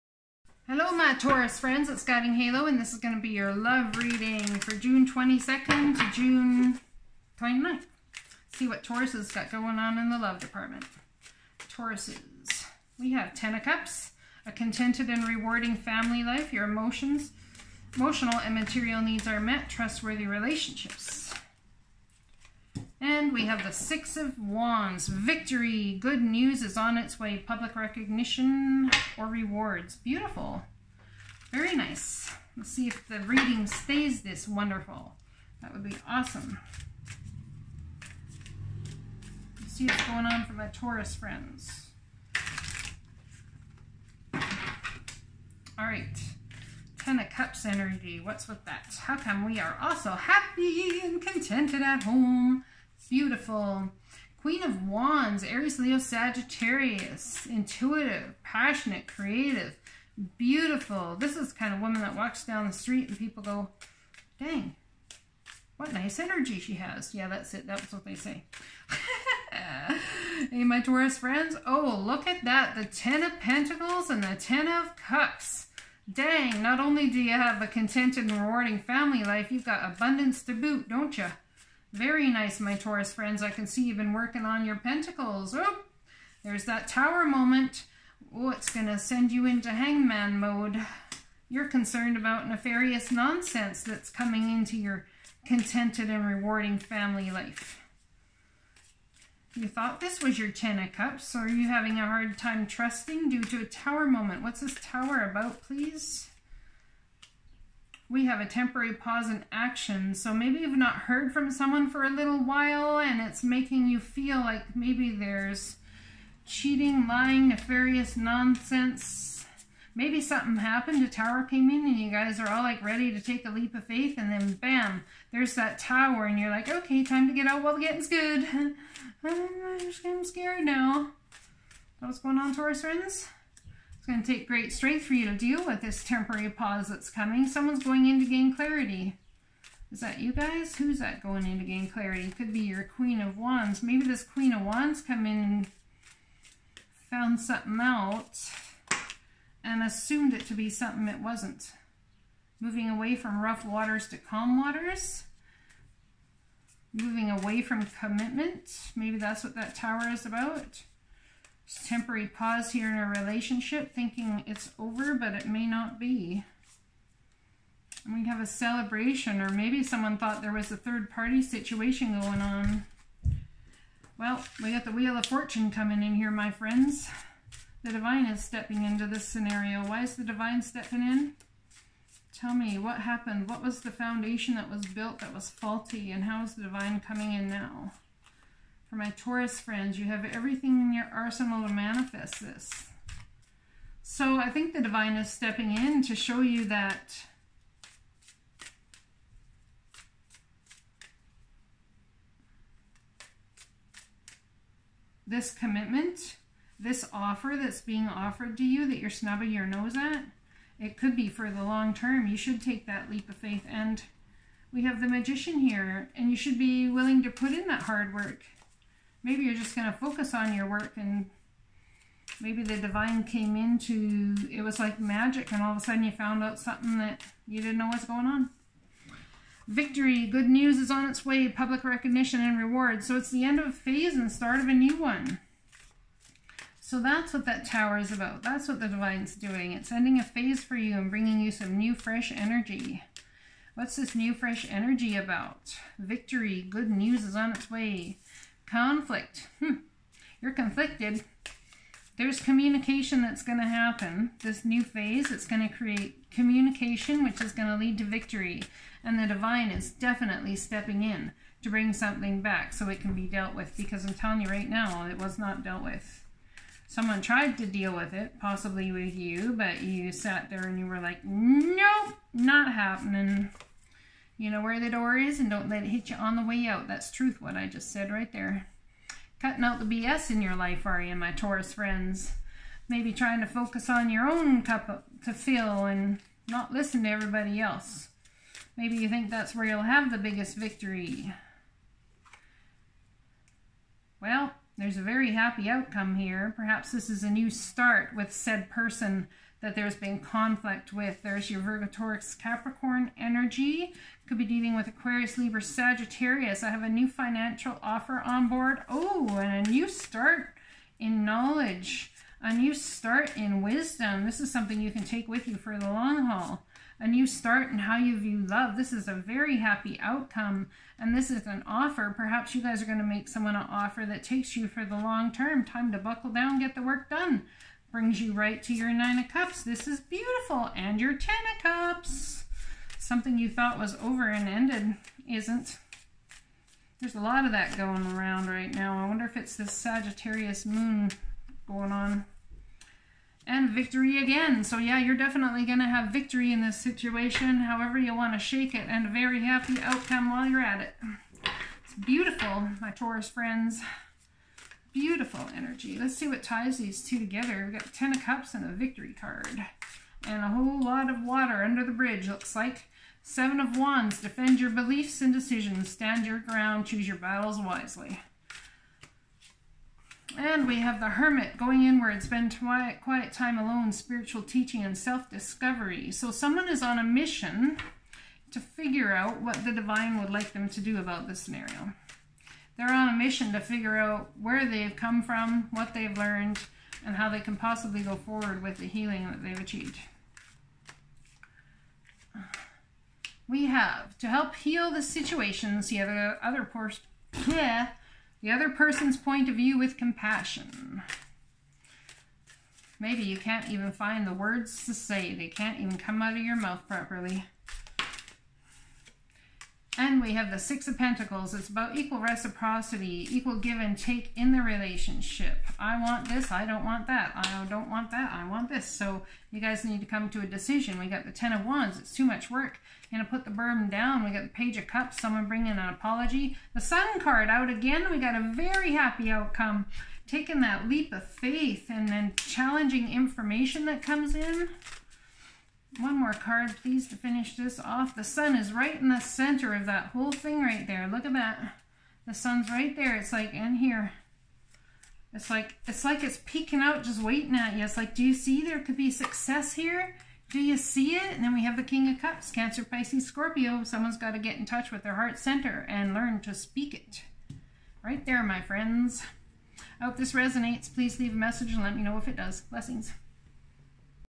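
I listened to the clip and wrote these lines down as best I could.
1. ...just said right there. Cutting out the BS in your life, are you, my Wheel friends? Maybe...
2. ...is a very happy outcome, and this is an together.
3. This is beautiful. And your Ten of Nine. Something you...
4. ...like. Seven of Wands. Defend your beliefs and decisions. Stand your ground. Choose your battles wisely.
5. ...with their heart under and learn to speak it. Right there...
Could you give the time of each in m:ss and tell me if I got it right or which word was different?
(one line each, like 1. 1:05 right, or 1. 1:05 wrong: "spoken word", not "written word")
1. 4:37 wrong: "Taurus", not "Wheel"
2. 5:18 wrong: "offer", not "together"
3. 5:29 wrong: "Cups", not "Nine"
4. 6:02 right
5. 7:34 wrong: "center", not "under".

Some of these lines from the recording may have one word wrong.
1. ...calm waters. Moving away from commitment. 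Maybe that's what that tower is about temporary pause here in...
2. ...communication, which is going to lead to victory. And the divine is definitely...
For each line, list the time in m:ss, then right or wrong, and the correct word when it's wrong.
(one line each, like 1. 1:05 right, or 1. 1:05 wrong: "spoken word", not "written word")
1. 2:34 right
2. 4:16 right.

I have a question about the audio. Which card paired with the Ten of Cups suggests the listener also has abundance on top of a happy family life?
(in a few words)
Ten of Pentacles.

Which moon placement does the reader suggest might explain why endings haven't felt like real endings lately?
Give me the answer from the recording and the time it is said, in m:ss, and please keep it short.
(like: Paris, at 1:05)
Sagittarius moon, at 5:39.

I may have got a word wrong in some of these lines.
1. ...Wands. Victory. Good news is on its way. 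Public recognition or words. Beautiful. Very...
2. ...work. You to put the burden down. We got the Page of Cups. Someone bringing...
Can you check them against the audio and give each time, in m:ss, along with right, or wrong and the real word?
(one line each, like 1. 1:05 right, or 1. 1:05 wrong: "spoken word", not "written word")
1. 0:24 wrong: "rewards", not "words"
2. 7:02 right.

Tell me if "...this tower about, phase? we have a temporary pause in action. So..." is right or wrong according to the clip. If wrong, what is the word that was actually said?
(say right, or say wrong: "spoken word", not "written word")
wrong: "please", not "phase".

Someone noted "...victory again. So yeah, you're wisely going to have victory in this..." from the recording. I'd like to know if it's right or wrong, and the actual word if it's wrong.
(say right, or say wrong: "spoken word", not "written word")
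wrong: "definitely", not "wisely".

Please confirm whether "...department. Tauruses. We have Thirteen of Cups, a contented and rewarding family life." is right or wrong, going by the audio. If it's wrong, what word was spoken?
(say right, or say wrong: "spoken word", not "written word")
wrong: "Ten", not "Thirteen".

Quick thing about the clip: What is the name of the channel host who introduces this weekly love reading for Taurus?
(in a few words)
Guiding Halo.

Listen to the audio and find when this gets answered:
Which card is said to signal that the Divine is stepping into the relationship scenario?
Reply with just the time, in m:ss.
2:54.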